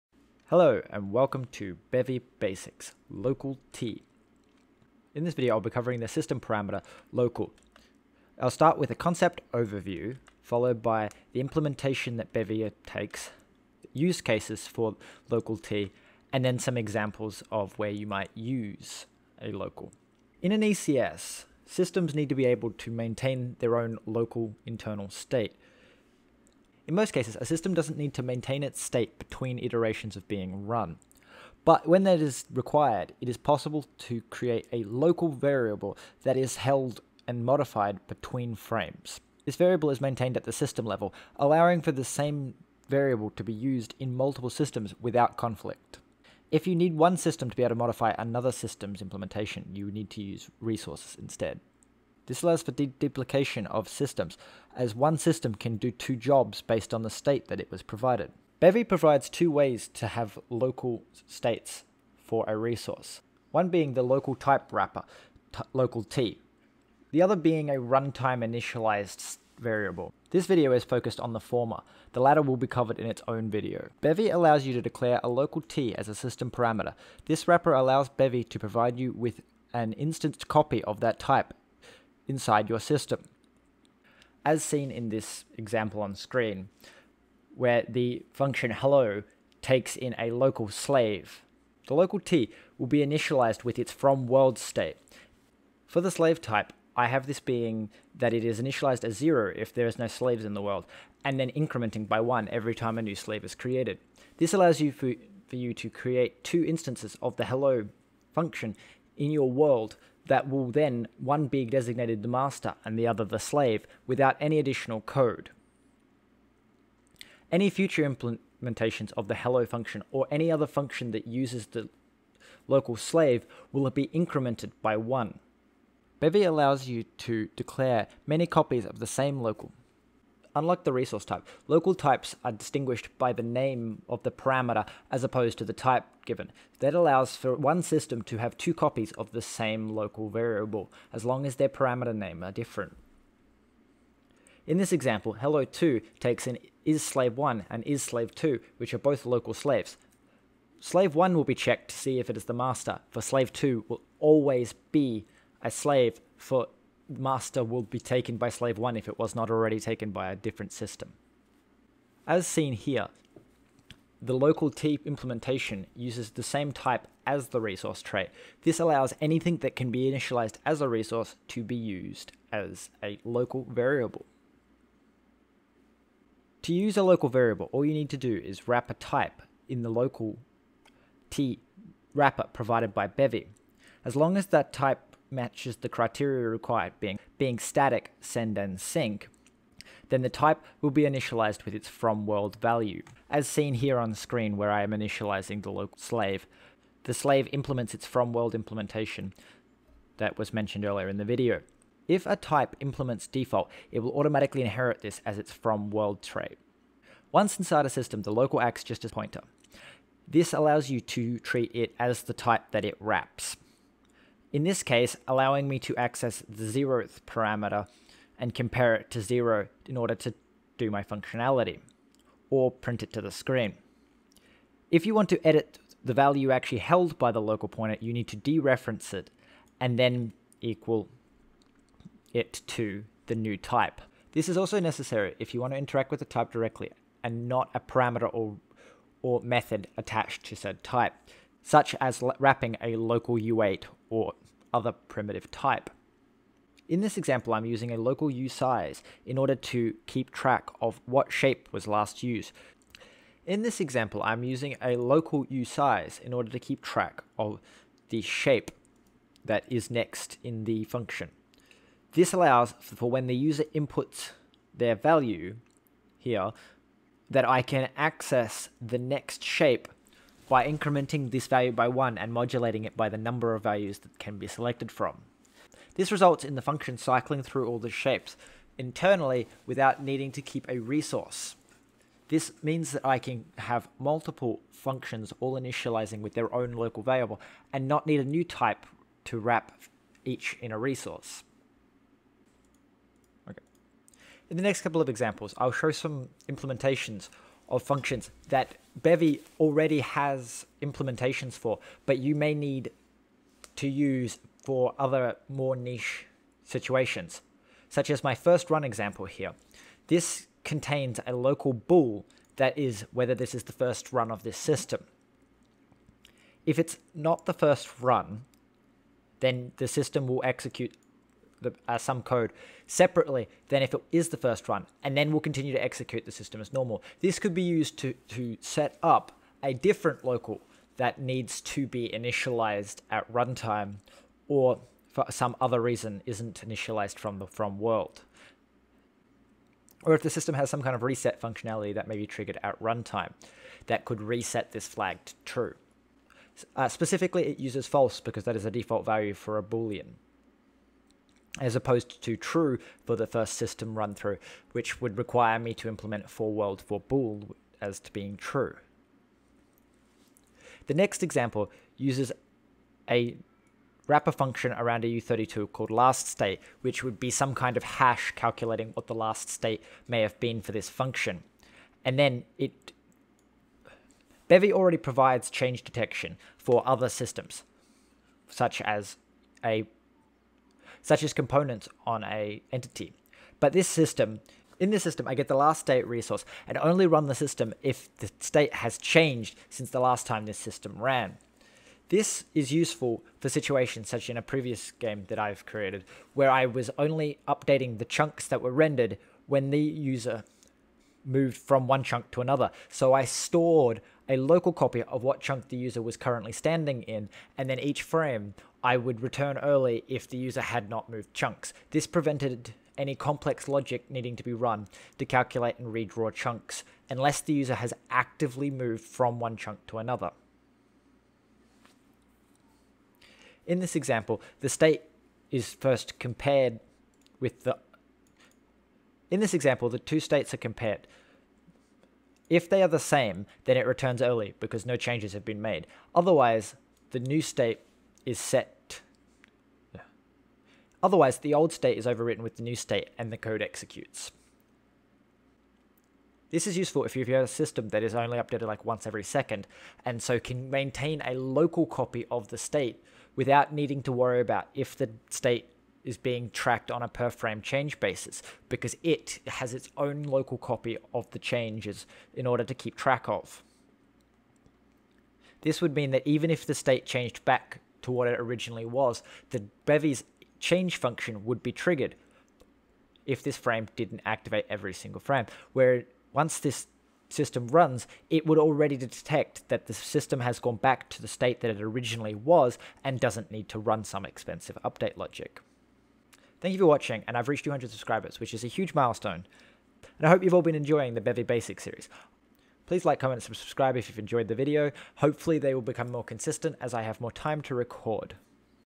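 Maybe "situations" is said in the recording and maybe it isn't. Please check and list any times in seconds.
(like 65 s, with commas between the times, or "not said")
306 s, 393 s.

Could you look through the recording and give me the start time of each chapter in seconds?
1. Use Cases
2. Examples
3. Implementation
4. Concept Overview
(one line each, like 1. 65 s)
1. 176 s
2. 246 s
3. 58 s
4. 20 s.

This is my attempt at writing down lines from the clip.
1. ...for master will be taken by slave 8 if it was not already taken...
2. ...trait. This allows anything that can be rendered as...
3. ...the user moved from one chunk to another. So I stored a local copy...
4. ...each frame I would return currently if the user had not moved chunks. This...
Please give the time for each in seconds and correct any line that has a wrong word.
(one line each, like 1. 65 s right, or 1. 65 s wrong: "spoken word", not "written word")
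1. 156 s wrong: "1", not "8"
2. 168 s wrong: "initialized", not "rendered"
3. 399 s right
4. 407 s wrong: "early", not "currently".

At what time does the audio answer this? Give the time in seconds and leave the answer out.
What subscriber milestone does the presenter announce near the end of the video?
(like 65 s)
487 s.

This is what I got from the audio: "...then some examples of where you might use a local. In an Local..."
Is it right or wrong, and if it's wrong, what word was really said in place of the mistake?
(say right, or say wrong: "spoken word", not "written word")
wrong: "ECS", not "Local".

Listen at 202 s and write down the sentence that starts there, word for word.
If a type implements default, it will automatically inherit this as its from world trait.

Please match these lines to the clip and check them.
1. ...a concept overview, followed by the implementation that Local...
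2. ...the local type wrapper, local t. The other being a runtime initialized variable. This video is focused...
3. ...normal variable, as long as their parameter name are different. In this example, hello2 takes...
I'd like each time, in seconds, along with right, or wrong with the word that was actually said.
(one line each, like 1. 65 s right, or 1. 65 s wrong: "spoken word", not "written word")
1. 8 s wrong: "Bevy", not "Local"
2. 63 s right
3. 139 s wrong: "local", not "normal".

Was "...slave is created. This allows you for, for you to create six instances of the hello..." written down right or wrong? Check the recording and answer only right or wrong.
wrong.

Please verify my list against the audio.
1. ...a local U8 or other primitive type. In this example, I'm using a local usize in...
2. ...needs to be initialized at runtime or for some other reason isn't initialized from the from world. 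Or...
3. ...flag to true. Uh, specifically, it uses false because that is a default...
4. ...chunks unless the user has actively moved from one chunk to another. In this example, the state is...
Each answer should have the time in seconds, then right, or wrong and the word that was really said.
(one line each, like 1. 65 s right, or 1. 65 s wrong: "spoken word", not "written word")
1. 242 s right
2. 331 s right
3. 344 s right
4. 416 s right.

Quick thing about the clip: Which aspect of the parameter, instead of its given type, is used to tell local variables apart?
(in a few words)
the name.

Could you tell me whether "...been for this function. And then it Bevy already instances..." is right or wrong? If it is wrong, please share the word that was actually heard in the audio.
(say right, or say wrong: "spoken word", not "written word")
wrong: "provides", not "instances".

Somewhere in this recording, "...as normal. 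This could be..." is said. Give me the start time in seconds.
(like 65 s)
326 s.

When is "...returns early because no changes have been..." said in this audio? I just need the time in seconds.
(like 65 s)
433 s.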